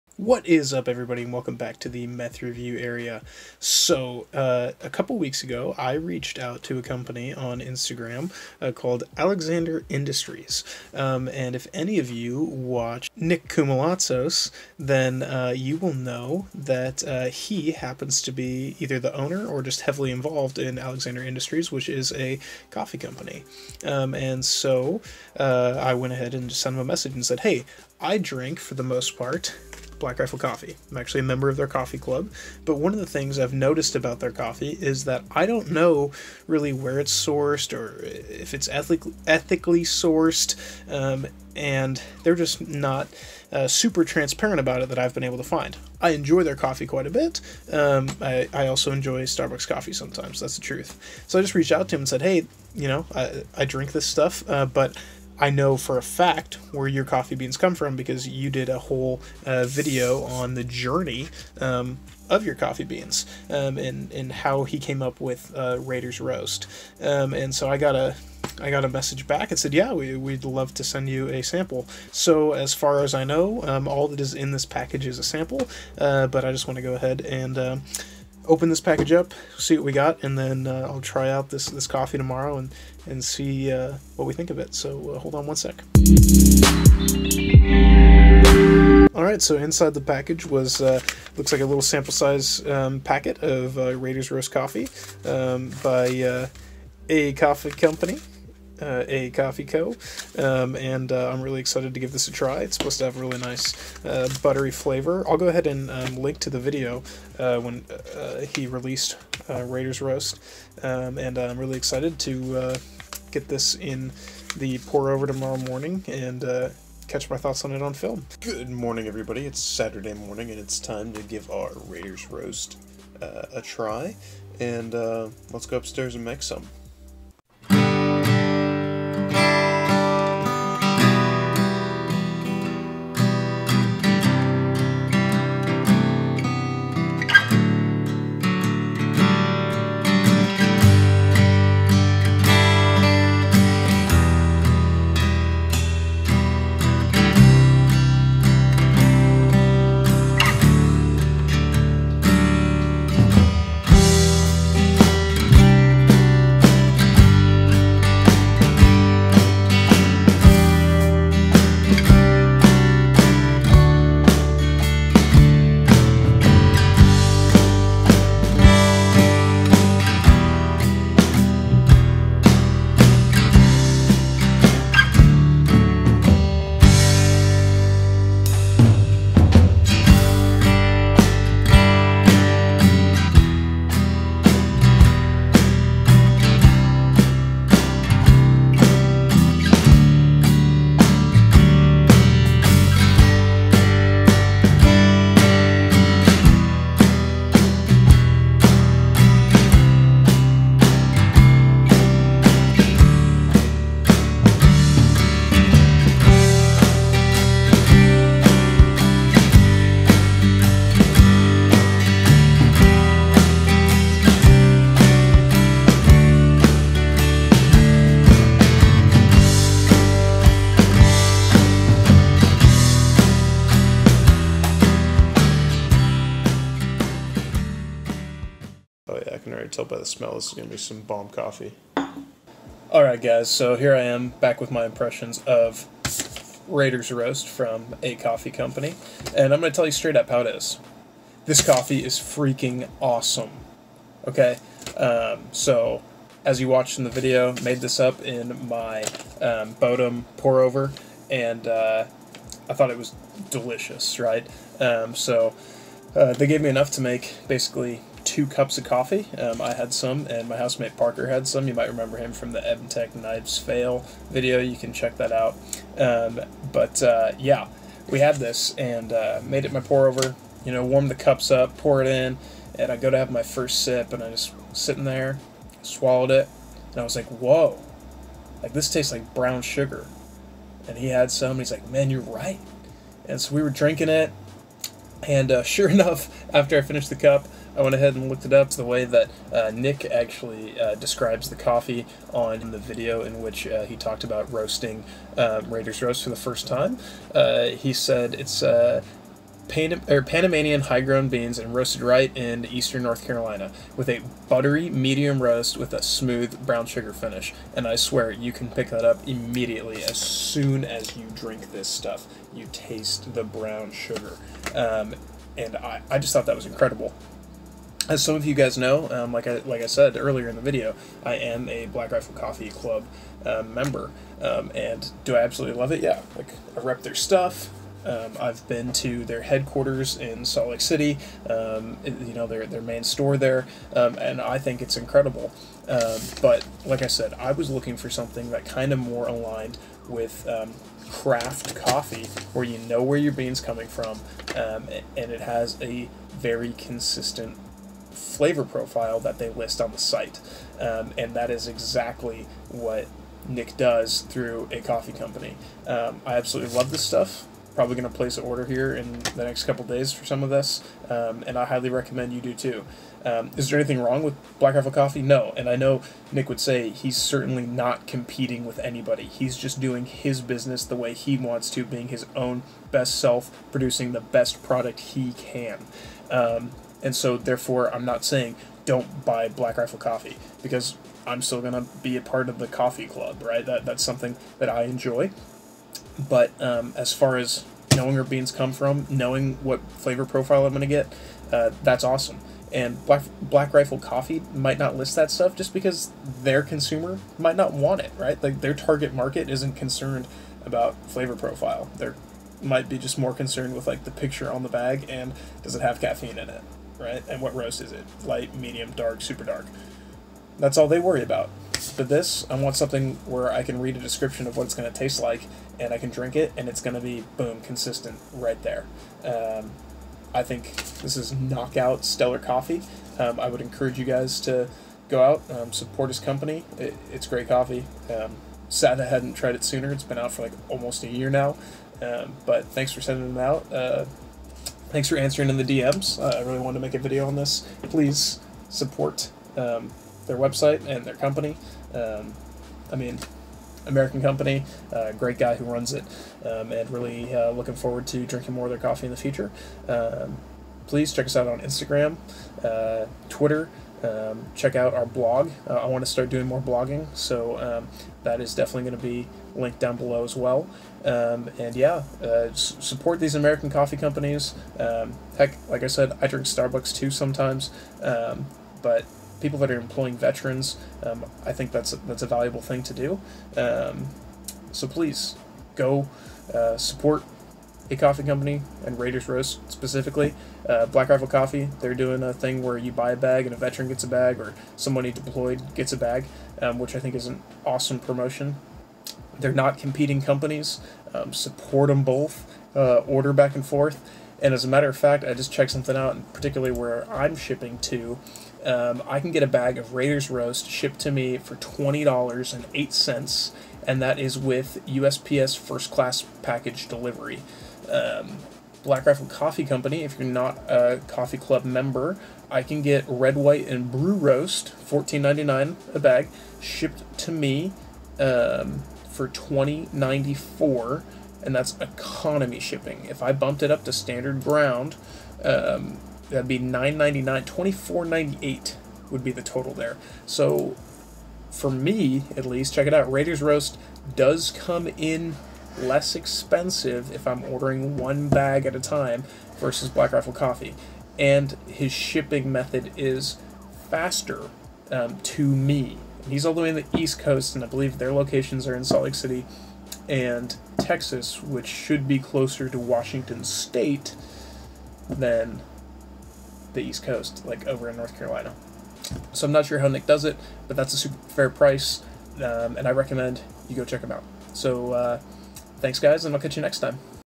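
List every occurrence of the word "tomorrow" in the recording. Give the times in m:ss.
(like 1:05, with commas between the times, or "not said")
1:22, 1:55.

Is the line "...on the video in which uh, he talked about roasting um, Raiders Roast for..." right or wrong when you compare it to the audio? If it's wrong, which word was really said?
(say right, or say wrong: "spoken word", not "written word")
right.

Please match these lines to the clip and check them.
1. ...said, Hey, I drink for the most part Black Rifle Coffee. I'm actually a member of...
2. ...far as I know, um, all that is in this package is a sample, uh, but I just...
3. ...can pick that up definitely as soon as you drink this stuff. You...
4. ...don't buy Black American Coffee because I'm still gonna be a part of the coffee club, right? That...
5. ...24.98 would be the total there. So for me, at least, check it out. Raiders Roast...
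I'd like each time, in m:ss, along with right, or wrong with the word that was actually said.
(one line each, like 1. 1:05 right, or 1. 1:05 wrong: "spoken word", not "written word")
1. 0:27 right
2. 1:12 right
3. 5:08 wrong: "immediately", not "definitely"
4. 6:18 wrong: "Rifle", not "American"
5. 8:47 right.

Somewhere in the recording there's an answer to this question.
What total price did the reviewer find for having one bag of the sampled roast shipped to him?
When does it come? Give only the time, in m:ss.
8:21.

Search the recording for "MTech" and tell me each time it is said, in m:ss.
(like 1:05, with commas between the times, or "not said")
4:22.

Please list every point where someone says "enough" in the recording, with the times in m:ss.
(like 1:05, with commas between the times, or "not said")
4:16, 4:45.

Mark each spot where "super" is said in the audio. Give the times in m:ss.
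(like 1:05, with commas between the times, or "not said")
0:43, 6:49, 9:20.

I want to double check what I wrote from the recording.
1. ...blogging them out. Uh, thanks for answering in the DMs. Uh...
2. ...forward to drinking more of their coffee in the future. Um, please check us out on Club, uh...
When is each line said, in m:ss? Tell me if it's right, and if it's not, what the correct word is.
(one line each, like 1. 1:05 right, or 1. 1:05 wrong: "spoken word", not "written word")
1. 7:13 wrong: "sending", not "blogging"
2. 7:27 wrong: "Instagram", not "Club".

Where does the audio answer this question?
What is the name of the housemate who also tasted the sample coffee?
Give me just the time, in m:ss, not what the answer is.
4:20.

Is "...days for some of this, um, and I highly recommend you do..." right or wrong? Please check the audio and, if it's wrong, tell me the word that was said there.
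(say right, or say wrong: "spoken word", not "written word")
right.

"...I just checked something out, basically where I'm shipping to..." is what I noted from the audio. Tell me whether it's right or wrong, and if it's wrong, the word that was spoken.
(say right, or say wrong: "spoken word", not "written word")
wrong: "particularly", not "basically".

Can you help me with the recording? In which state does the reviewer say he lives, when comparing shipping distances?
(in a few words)
Washington.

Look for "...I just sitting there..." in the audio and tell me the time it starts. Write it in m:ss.
4:34.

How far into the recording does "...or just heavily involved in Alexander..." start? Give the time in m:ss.
0:19.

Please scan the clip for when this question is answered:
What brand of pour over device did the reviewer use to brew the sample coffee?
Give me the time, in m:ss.
4:09.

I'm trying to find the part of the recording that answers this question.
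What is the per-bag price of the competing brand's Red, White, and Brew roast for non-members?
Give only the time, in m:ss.
8:34.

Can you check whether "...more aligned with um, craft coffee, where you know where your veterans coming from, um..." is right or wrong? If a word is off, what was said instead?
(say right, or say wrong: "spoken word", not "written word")
wrong: "beans", not "veterans".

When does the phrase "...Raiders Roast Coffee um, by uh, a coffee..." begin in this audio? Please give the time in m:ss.
1:33.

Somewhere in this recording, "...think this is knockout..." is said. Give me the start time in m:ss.
7:00.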